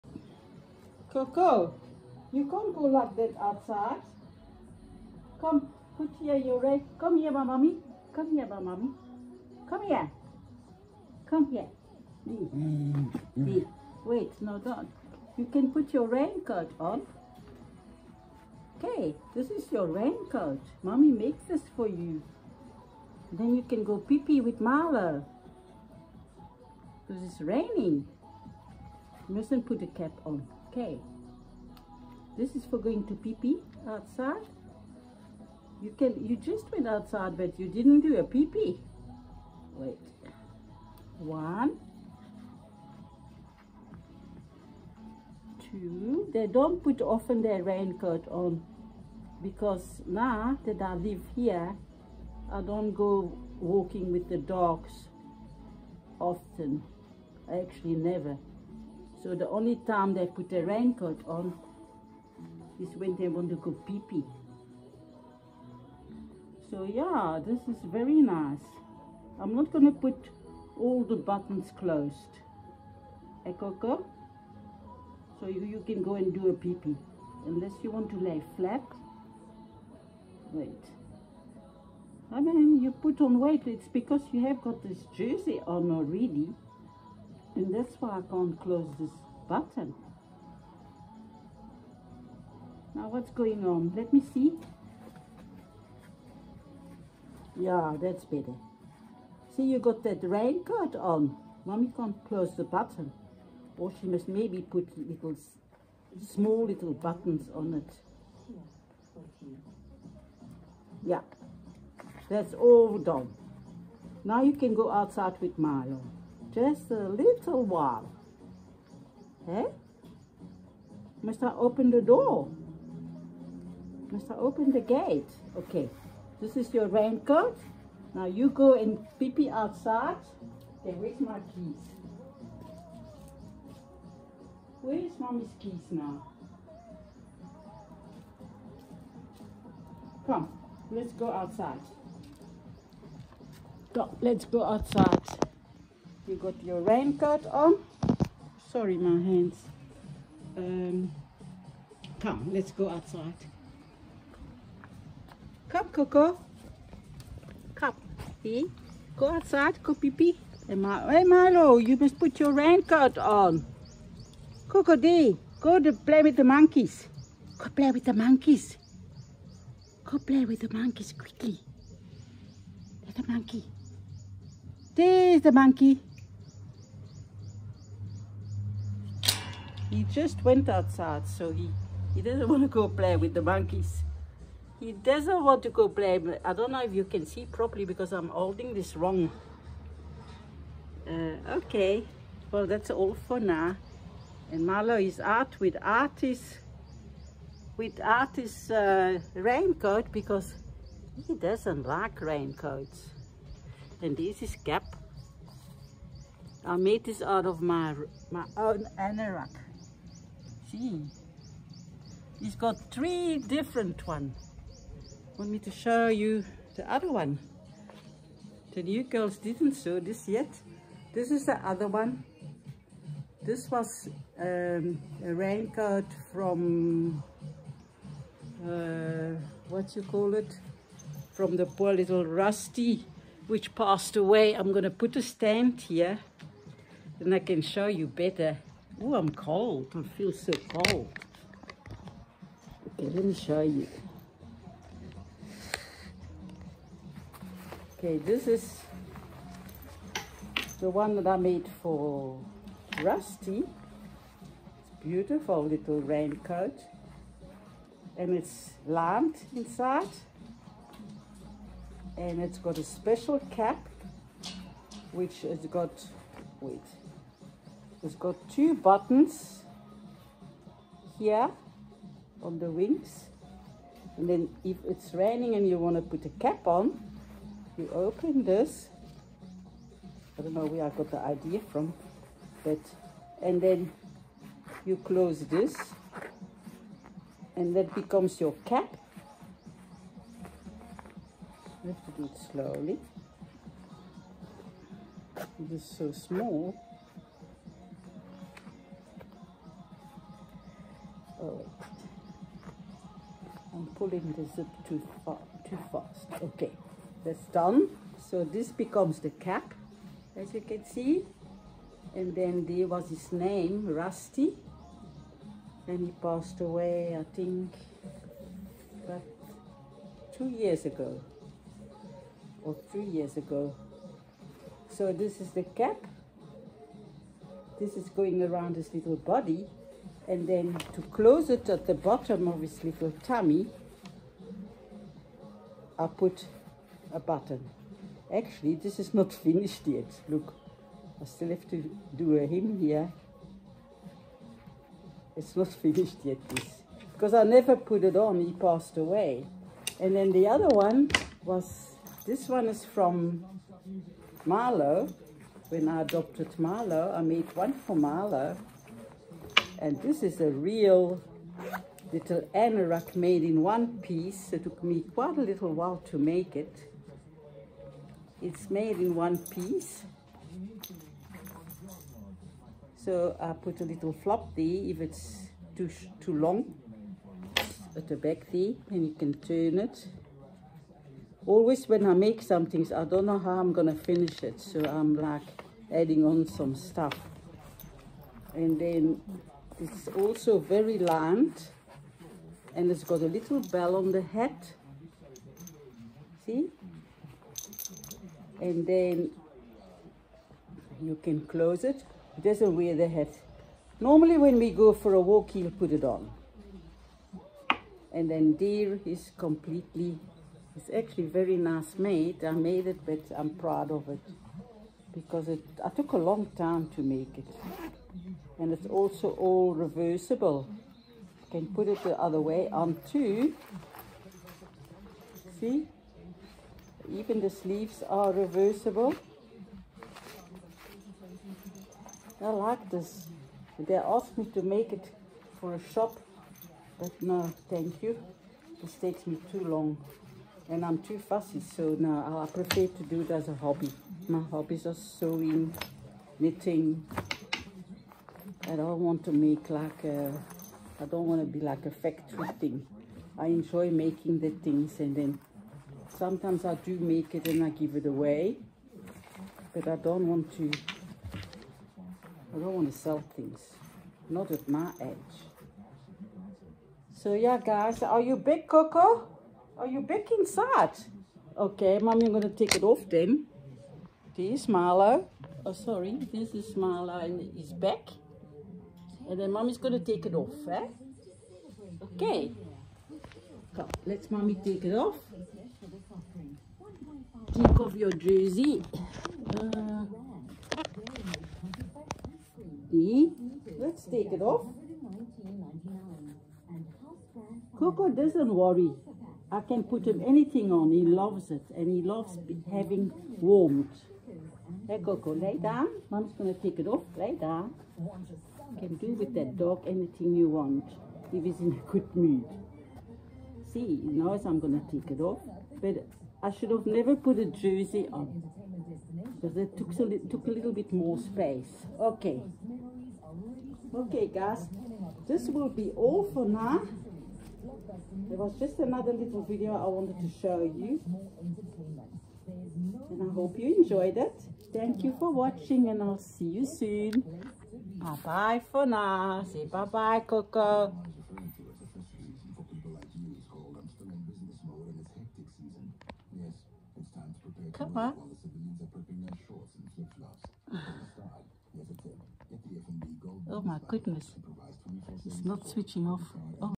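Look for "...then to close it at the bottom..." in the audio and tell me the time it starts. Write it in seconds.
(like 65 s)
330 s.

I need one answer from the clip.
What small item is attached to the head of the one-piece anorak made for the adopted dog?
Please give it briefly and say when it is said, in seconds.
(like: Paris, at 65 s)
a little bell, at 393 s.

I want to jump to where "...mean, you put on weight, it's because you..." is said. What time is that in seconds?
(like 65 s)
82 s.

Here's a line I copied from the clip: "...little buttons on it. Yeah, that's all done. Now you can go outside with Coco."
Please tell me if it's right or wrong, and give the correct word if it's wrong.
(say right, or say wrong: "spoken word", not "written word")
wrong: "Milo", not "Coco".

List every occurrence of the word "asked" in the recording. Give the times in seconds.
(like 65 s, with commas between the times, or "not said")
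433 s.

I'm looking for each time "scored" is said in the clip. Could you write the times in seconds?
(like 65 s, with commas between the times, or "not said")
not said.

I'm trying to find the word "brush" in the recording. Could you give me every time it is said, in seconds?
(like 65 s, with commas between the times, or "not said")
not said.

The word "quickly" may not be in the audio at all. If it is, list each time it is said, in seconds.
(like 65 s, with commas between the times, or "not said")
171 s.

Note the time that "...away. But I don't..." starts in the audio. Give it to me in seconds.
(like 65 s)
458 s.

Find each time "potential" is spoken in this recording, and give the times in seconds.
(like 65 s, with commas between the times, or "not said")
not said.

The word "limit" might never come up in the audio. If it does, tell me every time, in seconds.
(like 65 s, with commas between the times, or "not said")
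not said.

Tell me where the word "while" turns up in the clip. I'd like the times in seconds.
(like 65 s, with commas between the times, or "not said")
117 s, 365 s.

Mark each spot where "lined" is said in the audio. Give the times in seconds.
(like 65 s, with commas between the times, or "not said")
258 s, 390 s.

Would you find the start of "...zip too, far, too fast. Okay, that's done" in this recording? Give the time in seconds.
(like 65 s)
304 s.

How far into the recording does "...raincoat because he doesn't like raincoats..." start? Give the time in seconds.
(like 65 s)
199 s.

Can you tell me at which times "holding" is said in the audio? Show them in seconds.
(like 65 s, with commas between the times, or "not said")
188 s.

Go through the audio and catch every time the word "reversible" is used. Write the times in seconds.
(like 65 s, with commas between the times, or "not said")
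419 s, 428 s.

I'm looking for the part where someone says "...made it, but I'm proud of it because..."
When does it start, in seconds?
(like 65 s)
412 s.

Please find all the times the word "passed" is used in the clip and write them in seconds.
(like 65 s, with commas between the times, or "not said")
233 s, 316 s, 348 s.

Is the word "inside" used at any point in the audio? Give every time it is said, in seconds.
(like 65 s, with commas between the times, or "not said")
259 s, 470 s.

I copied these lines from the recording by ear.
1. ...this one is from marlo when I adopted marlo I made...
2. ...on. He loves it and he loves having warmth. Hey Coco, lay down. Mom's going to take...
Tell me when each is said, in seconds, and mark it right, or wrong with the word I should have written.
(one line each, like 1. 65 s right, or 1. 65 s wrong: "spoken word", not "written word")
1. 352 s right
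2. 500 s right.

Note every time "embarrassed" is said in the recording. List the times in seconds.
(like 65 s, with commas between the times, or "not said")
not said.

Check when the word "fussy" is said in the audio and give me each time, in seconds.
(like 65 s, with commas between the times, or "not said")
441 s.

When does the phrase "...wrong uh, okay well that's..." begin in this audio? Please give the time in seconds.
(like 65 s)
188 s.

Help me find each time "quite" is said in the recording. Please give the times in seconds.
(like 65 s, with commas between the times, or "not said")
365 s.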